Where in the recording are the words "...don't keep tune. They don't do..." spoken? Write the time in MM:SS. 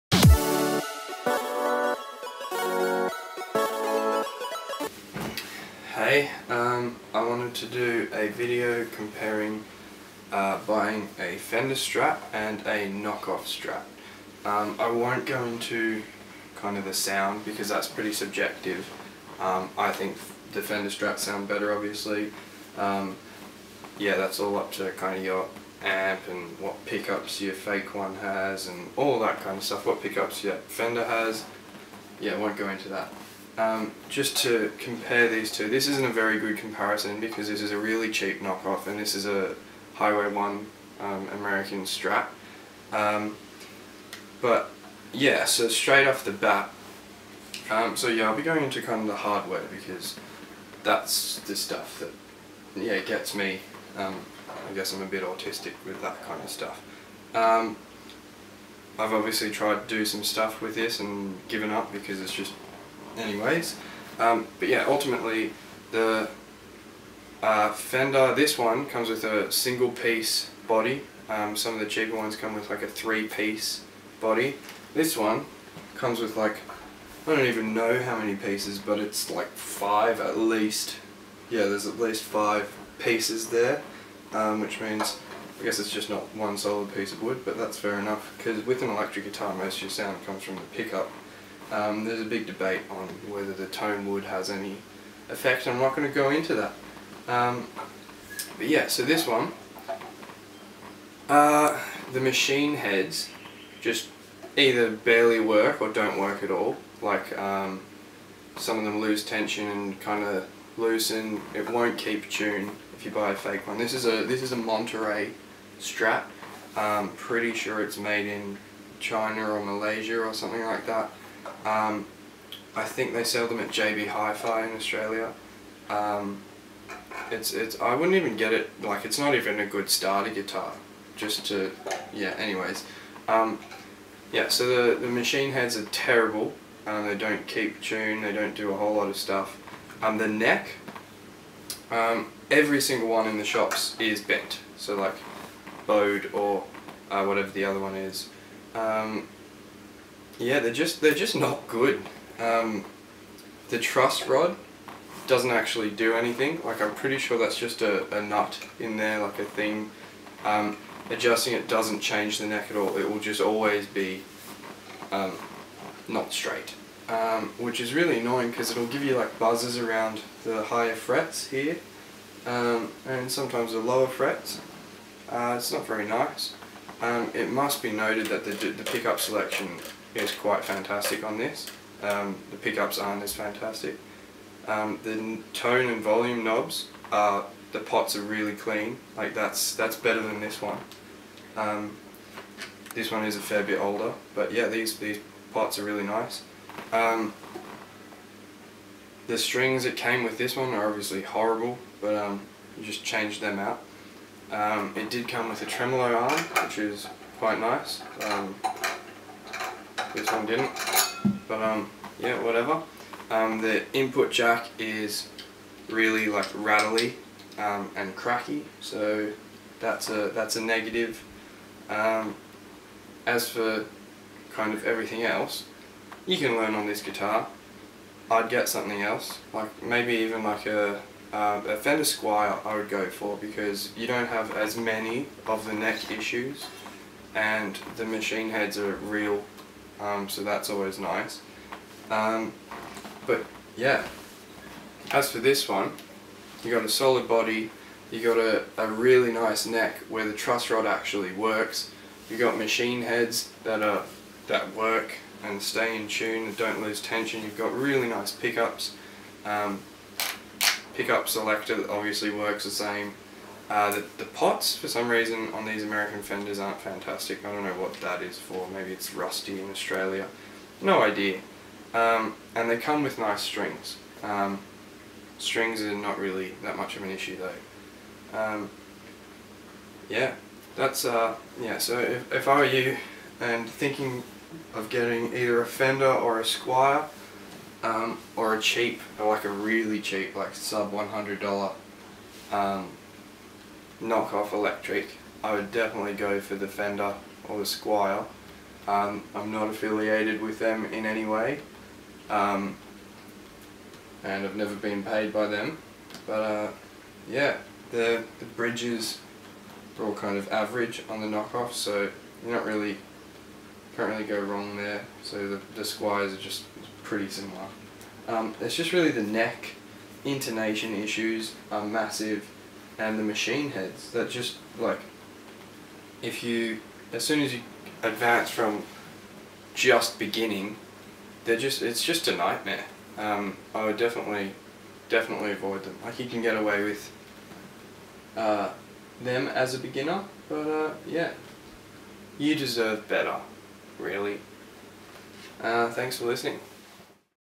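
02:17.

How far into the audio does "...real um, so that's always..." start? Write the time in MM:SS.
03:58.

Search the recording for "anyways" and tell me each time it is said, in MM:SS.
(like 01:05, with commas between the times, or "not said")
01:03, 02:12.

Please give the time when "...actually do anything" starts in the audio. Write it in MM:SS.
02:35.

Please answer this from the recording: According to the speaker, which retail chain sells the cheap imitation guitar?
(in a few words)
JB Hi-Fi.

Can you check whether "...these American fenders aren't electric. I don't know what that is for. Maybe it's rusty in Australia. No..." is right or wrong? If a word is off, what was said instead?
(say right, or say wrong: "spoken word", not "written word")
wrong: "fantastic", not "electric".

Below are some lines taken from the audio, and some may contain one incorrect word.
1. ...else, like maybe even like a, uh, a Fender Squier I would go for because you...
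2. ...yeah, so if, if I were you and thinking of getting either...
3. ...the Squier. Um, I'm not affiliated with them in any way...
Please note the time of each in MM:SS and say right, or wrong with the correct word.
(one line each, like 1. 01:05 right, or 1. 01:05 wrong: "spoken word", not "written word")
1. 03:49 right
2. 04:41 right
3. 04:57 right.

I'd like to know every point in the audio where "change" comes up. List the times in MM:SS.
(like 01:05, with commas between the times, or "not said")
02:41, 03:23.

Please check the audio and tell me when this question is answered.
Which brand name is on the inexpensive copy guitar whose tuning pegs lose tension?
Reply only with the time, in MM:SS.
01:54.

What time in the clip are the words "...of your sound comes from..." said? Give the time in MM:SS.
01:29.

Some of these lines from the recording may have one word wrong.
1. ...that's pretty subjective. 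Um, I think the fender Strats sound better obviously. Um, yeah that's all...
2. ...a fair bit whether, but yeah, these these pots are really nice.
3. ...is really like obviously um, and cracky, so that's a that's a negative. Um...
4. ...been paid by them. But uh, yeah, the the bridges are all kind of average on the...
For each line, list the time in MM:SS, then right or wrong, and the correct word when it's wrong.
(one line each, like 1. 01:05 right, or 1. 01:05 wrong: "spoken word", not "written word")
1. 00:17 right
2. 03:13 wrong: "older", not "whether"
3. 03:34 wrong: "rattly", not "obviously"
4. 05:04 right.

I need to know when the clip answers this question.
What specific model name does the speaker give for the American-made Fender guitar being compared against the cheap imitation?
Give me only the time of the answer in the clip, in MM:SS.
00:39.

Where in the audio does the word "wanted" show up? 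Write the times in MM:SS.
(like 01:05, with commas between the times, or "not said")
00:07.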